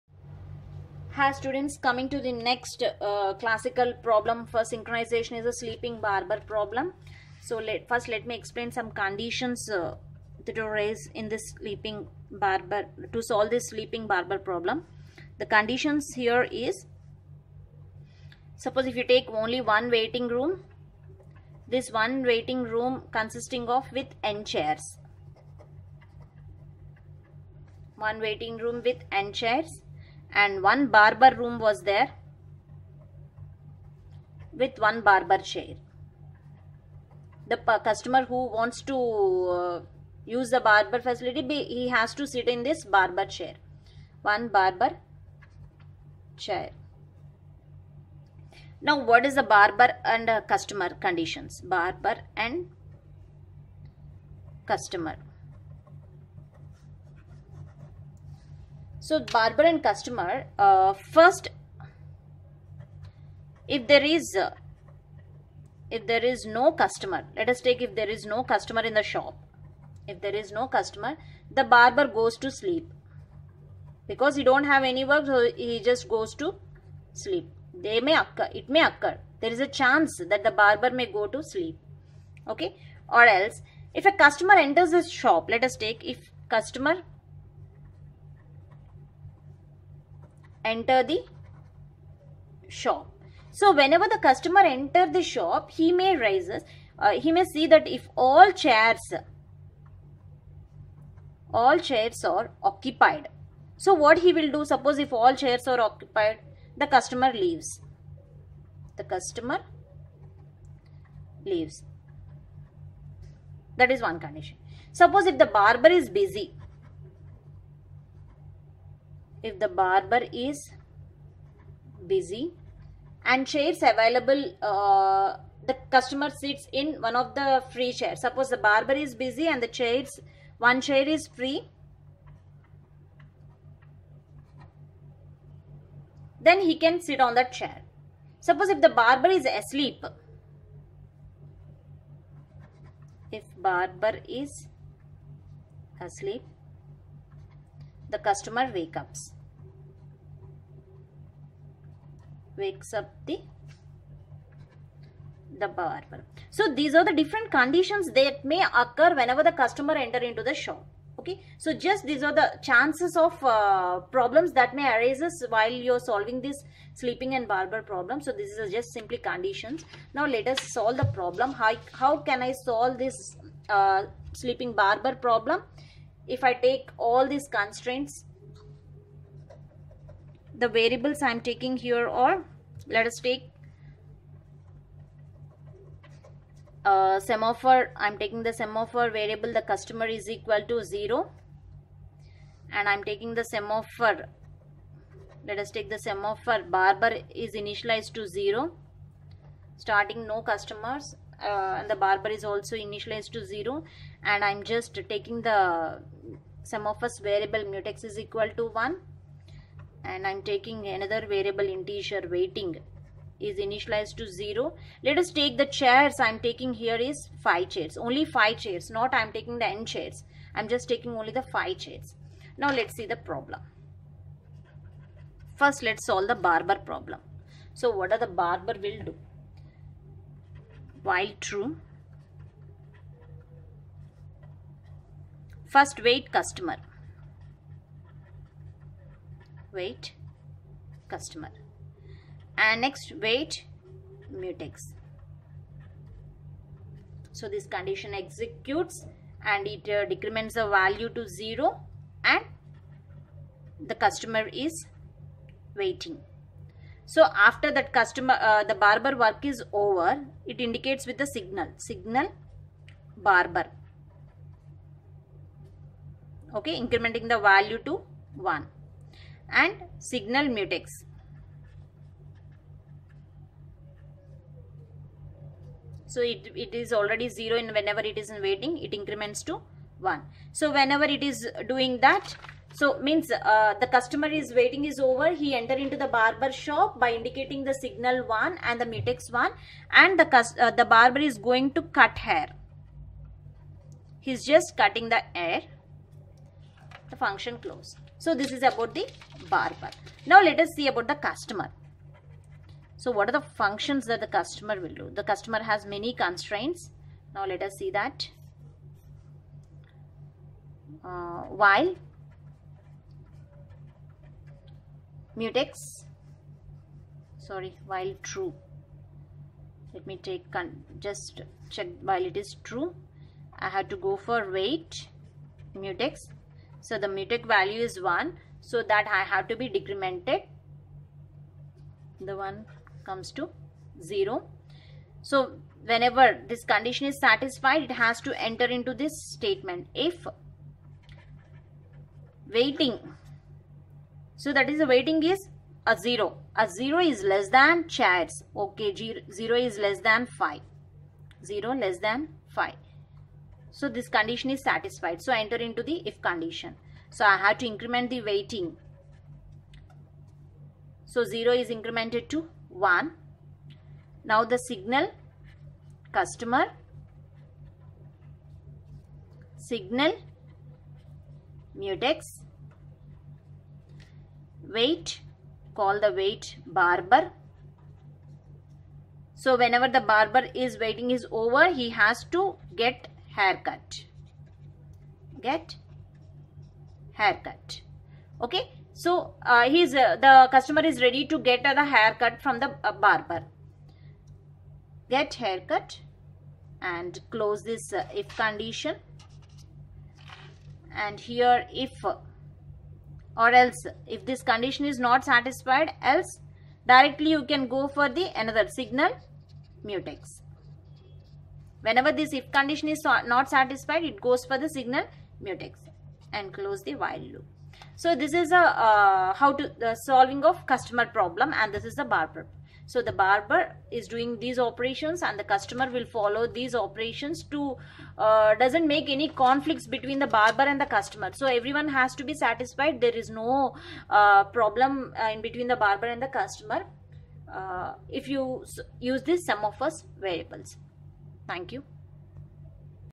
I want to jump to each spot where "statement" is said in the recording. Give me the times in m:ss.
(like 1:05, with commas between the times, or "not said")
5:39.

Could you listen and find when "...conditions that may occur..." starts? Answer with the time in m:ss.
2:37.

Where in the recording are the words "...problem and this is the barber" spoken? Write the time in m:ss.
7:01.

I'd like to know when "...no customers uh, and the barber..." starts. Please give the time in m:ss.
3:20.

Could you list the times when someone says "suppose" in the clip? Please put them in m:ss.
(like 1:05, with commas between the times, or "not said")
0:18, 1:44, 1:54, 2:08, 2:18.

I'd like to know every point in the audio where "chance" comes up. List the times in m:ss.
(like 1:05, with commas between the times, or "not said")
1:19, 2:42.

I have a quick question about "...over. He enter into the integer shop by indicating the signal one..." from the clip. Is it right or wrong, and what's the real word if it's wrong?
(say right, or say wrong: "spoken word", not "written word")
wrong: "barber", not "integer".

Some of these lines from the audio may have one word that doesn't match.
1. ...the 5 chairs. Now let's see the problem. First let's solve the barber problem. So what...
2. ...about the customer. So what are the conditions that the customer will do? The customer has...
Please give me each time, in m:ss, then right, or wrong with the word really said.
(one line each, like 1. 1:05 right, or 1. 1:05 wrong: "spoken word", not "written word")
1. 3:41 right
2. 5:00 wrong: "functions", not "conditions".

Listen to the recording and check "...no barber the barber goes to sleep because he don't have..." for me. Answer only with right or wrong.
wrong.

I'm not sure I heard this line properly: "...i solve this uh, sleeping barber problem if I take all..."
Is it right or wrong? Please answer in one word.
right.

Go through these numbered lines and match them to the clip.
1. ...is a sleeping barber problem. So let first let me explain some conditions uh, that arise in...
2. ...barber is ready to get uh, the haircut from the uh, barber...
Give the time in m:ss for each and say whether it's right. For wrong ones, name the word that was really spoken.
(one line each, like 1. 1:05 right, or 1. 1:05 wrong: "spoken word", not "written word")
1. 0:05 right
2. 6:30 wrong: "customer", not "barber".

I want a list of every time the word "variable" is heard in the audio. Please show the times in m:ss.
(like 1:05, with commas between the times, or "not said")
3:00, 3:09, 3:27, 3:31, 7:20.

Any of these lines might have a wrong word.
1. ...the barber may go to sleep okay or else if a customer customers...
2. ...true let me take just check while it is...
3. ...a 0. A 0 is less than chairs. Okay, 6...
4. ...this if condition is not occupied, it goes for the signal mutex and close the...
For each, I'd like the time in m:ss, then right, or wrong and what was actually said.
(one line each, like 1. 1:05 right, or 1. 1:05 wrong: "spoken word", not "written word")
1. 1:20 wrong: "enters", not "customers"
2. 5:18 right
3. 5:45 wrong: "0", not "6"
4. 6:52 wrong: "satisfied", not "occupied".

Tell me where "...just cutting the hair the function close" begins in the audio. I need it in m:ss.
4:54.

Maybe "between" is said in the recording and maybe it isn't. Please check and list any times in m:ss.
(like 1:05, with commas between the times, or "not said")
7:09, 7:15.